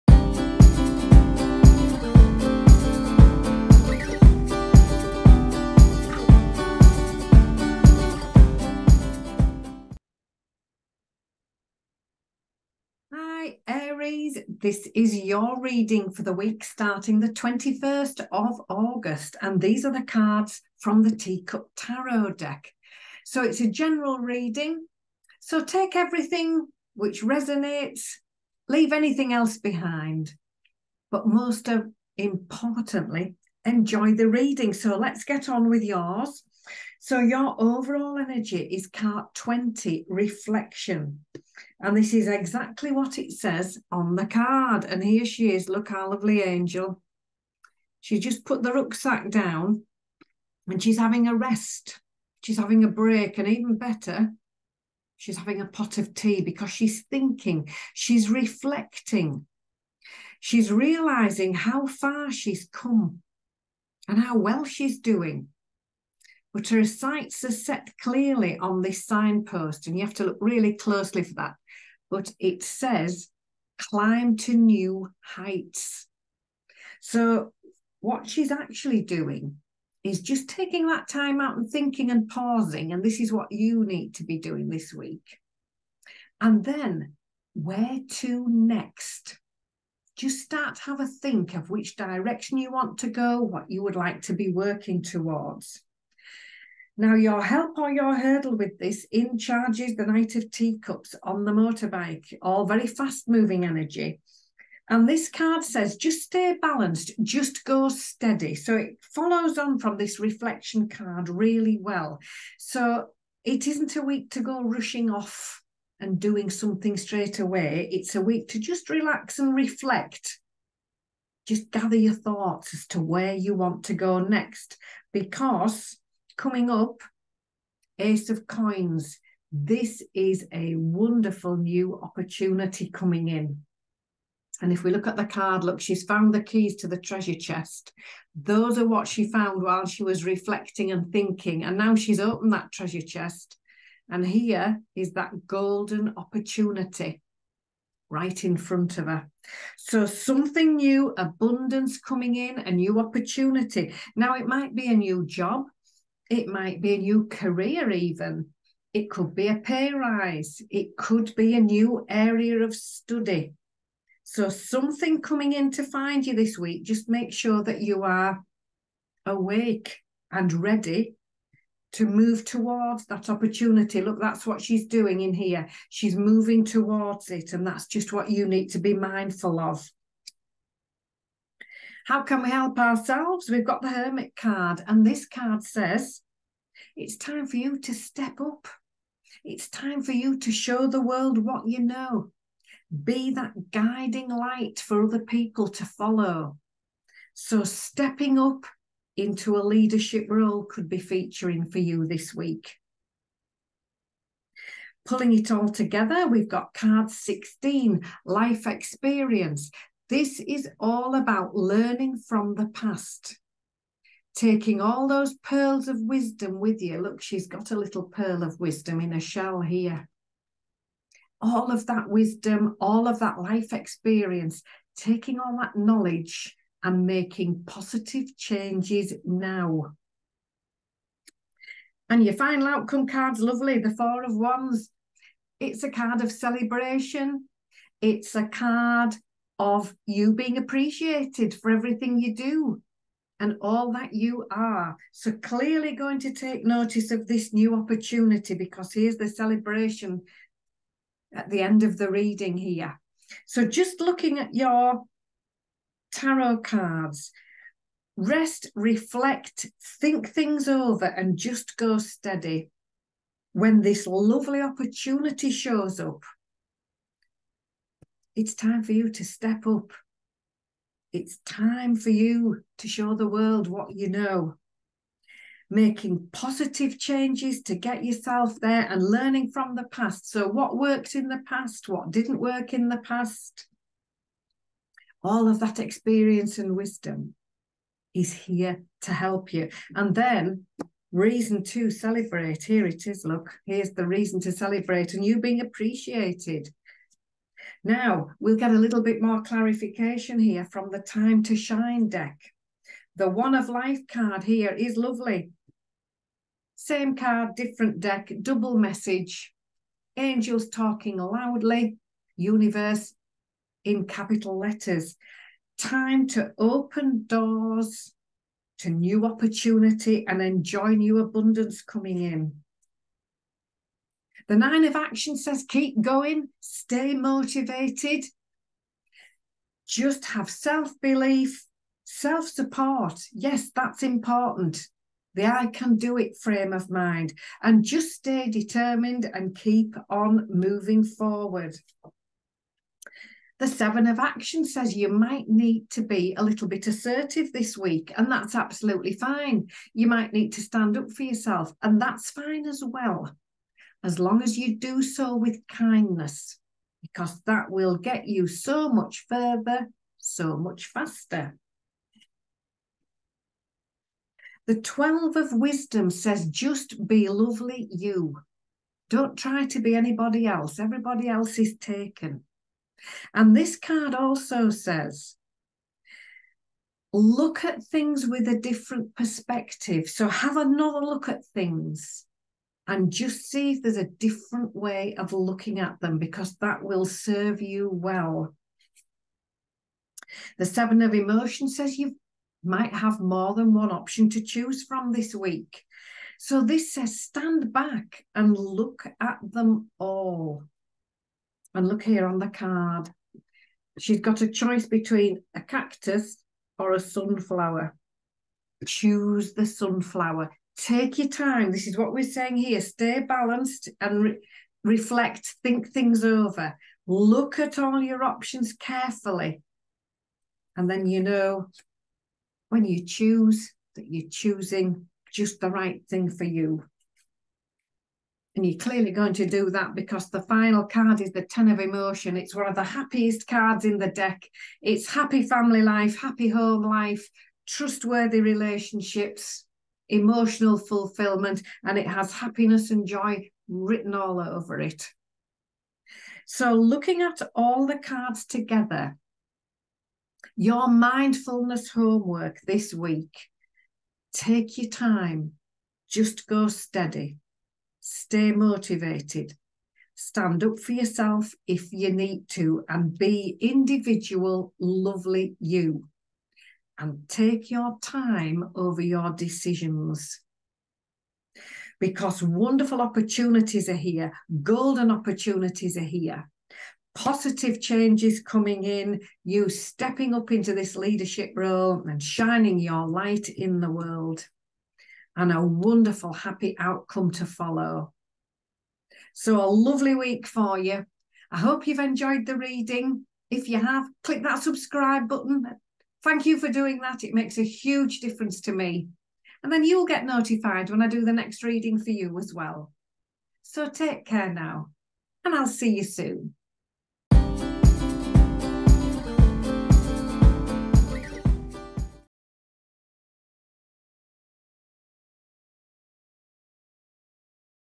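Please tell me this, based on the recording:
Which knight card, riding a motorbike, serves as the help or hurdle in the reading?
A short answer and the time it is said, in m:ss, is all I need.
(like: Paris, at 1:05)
Knight of Teacups, at 1:40.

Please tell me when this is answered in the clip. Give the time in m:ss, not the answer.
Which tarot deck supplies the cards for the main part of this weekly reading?
0:21.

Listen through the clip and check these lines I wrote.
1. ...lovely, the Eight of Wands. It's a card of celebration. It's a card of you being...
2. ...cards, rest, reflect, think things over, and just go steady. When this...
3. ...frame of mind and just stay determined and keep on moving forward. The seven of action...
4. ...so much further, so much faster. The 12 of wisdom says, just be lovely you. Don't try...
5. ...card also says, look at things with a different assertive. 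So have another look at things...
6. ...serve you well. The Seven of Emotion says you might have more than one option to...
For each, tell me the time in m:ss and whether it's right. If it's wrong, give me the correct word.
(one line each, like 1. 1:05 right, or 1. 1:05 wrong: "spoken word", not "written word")
1. 3:53 wrong: "Four", not "Eight"
2. 4:16 right
3. 5:36 right
4. 5:58 right
5. 6:13 wrong: "perspective", not "assertive"
6. 6:27 right.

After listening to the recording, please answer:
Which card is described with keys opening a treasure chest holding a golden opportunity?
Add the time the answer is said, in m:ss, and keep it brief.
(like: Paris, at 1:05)
Ace of Coins, at 2:07.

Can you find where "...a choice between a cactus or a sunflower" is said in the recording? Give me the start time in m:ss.
6:44.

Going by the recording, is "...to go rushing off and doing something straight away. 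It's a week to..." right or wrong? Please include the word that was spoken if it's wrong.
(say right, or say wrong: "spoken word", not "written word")
right.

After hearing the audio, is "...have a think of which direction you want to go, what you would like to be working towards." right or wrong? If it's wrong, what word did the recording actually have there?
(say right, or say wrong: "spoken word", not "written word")
right.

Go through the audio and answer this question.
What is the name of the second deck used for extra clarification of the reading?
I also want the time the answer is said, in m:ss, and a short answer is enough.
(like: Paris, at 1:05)
Time to Shine, at 5:00.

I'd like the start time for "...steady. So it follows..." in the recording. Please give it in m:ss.
1:47.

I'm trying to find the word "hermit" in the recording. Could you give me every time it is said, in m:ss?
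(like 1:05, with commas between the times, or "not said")
3:03.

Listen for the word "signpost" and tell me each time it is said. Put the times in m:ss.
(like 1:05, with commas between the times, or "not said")
1:09.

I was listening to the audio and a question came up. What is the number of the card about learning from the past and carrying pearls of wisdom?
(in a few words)
16.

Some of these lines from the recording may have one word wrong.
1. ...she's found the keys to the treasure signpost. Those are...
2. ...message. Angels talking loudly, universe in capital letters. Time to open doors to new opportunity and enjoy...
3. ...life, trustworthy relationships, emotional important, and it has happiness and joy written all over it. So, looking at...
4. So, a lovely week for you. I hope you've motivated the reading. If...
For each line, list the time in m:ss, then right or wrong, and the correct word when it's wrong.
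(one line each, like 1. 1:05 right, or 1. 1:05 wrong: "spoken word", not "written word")
1. 2:15 wrong: "chest", not "signpost"
2. 5:08 right
3. 7:16 wrong: "fulfillment", not "important"
4. 8:09 wrong: "enjoyed", not "motivated".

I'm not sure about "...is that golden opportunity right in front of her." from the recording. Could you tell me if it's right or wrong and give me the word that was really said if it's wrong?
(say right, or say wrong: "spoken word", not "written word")
right.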